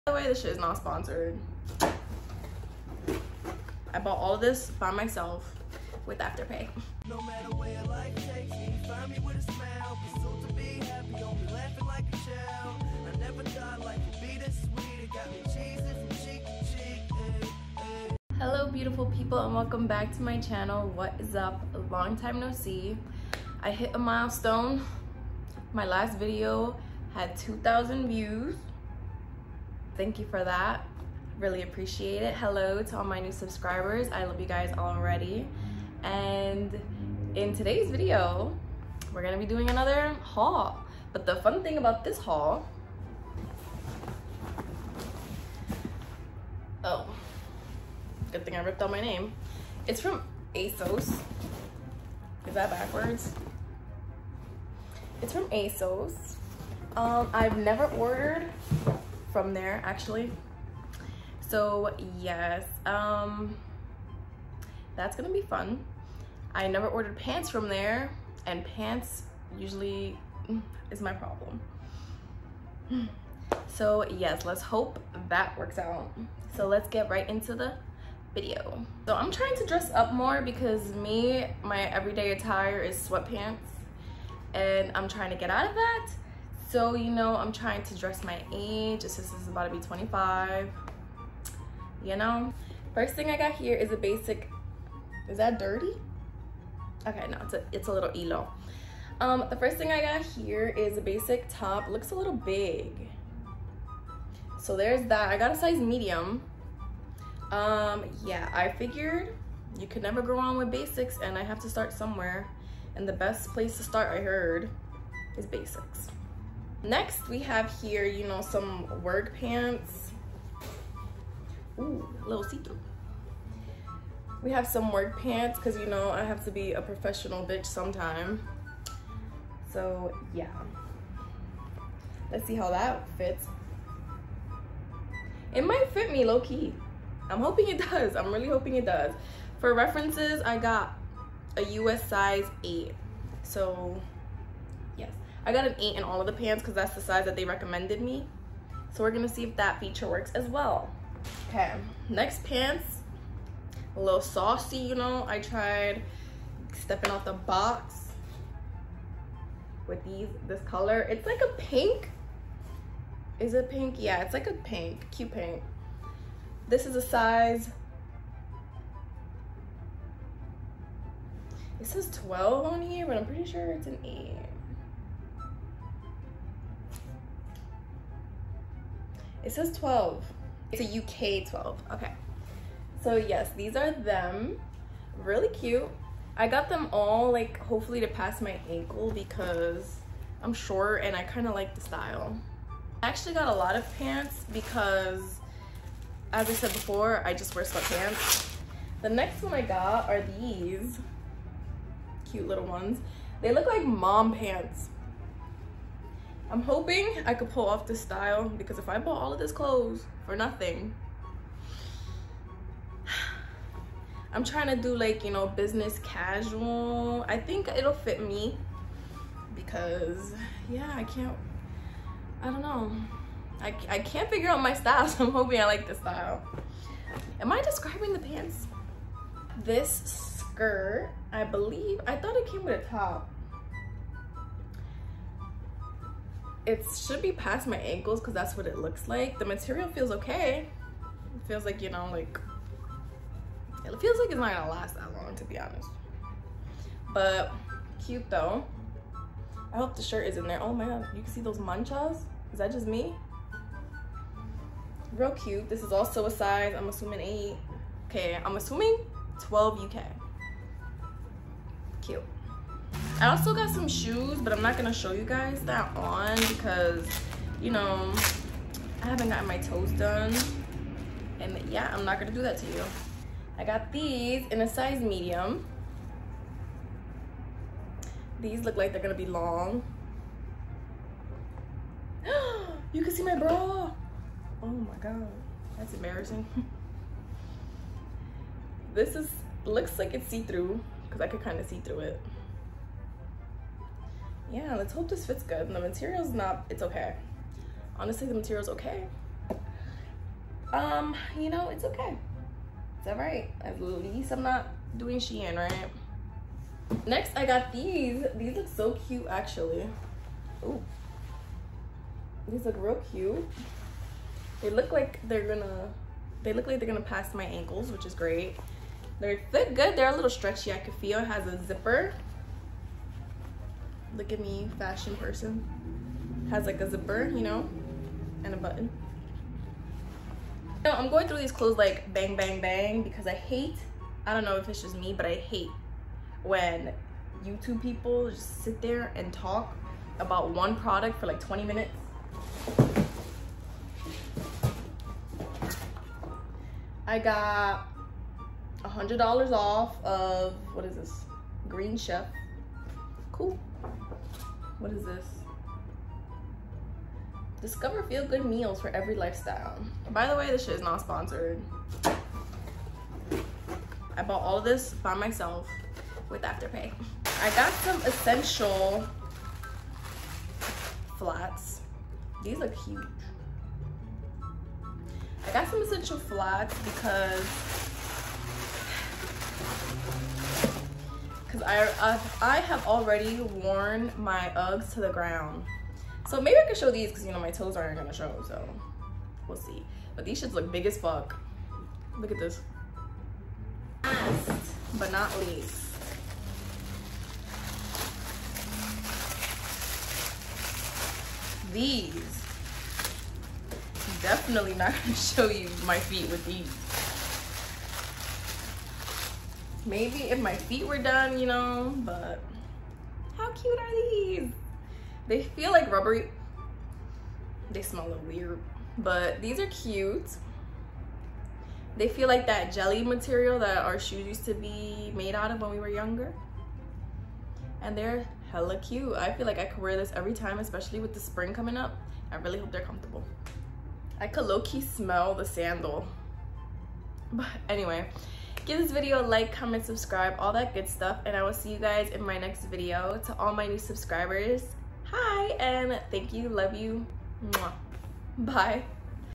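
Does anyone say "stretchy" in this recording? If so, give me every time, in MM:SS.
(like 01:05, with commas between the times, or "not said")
05:20.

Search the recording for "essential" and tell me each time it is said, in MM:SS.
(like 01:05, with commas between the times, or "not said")
06:08, 06:15.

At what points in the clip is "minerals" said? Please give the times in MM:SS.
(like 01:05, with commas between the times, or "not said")
not said.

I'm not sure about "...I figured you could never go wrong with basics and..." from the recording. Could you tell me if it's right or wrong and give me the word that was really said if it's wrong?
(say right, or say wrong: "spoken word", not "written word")
right.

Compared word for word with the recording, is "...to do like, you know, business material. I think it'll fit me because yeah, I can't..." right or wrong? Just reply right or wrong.
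wrong.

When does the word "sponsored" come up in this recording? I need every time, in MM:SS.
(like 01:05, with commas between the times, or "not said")
00:00, 06:01.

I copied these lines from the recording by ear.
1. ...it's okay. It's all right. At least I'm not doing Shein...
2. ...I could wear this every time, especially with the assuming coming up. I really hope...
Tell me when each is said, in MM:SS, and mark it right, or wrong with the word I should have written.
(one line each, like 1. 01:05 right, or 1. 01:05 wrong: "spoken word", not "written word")
1. 05:01 right
2. 07:09 wrong: "spring", not "assuming".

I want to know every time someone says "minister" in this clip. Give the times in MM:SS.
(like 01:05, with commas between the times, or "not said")
not said.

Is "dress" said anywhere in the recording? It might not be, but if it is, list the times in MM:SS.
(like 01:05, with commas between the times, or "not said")
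01:19, 01:27.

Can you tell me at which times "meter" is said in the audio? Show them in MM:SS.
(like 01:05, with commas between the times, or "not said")
not said.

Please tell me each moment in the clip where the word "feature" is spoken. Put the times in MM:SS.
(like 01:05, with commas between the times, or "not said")
02:29.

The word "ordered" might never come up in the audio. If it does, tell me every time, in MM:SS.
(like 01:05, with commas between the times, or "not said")
00:57, 01:06.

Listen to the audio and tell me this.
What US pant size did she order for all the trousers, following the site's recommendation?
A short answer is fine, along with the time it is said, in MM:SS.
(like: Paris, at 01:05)
8, at 02:21.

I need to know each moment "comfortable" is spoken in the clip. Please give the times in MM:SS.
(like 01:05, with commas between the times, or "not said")
07:12.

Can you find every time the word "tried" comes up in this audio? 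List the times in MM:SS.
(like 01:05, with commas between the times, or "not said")
02:35.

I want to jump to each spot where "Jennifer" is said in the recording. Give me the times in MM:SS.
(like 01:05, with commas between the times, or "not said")
not said.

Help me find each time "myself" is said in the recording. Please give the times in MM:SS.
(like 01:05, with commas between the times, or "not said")
00:04, 06:05.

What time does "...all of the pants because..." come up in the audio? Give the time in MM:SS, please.
02:26.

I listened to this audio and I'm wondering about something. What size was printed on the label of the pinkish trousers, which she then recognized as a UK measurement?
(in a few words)
12.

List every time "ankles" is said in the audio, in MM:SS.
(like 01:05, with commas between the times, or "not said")
03:08, 03:57, 05:17.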